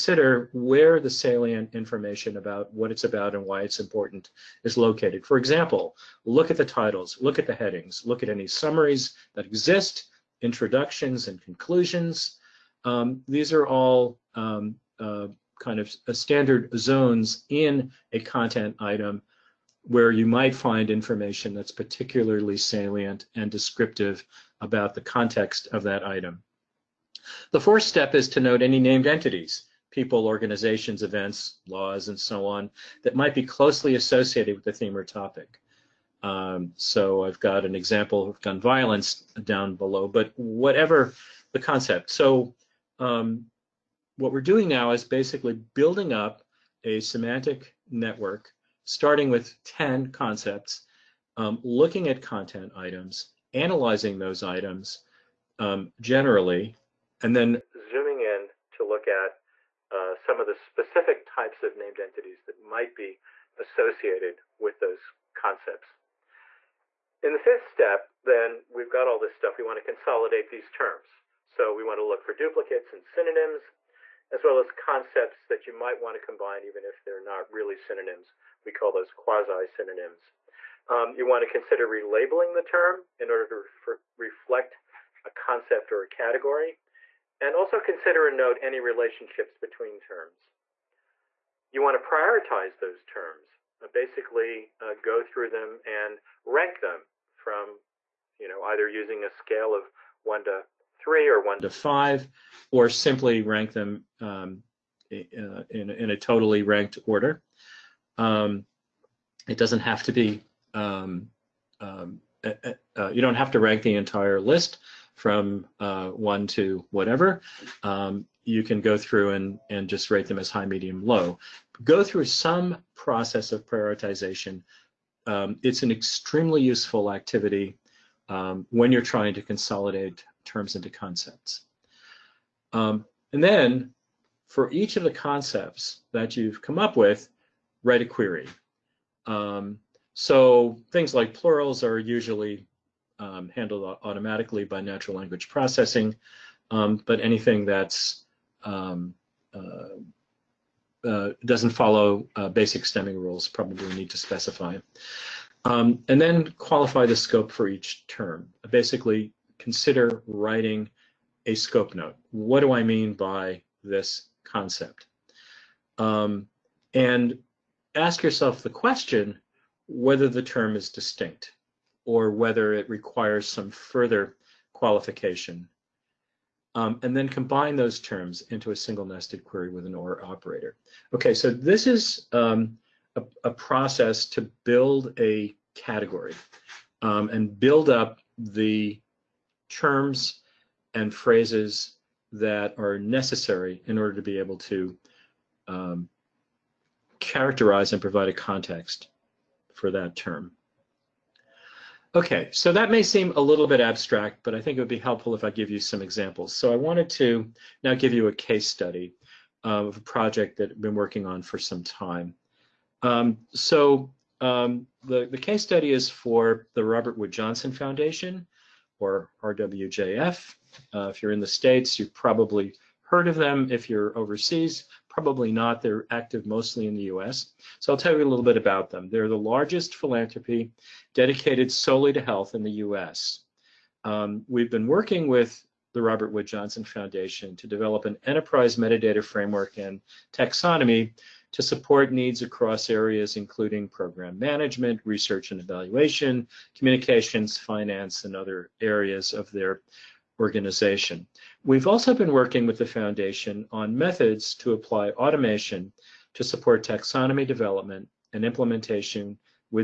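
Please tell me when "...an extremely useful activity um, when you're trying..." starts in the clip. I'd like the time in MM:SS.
02:05.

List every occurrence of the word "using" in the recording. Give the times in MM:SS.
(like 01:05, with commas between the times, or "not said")
01:38.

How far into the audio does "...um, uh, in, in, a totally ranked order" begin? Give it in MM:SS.
01:44.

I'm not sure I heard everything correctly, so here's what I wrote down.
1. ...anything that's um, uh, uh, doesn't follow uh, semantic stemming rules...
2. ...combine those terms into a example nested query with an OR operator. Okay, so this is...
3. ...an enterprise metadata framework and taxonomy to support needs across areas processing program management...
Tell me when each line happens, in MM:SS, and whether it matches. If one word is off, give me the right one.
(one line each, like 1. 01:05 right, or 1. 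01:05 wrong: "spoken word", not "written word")
1. 02:27 wrong: "basic", not "semantic"
2. 02:57 wrong: "single", not "example"
3. 03:58 wrong: "including", not "processing".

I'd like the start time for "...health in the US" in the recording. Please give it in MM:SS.
03:52.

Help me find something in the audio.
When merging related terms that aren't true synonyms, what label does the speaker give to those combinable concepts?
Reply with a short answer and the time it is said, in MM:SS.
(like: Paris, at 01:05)
quasi-synonyms, at 01:19.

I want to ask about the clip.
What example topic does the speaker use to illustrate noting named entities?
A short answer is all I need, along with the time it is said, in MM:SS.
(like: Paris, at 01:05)
gun violence, at 00:38.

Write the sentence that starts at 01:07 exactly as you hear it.
In the fifth step, then, we've got all this stuff.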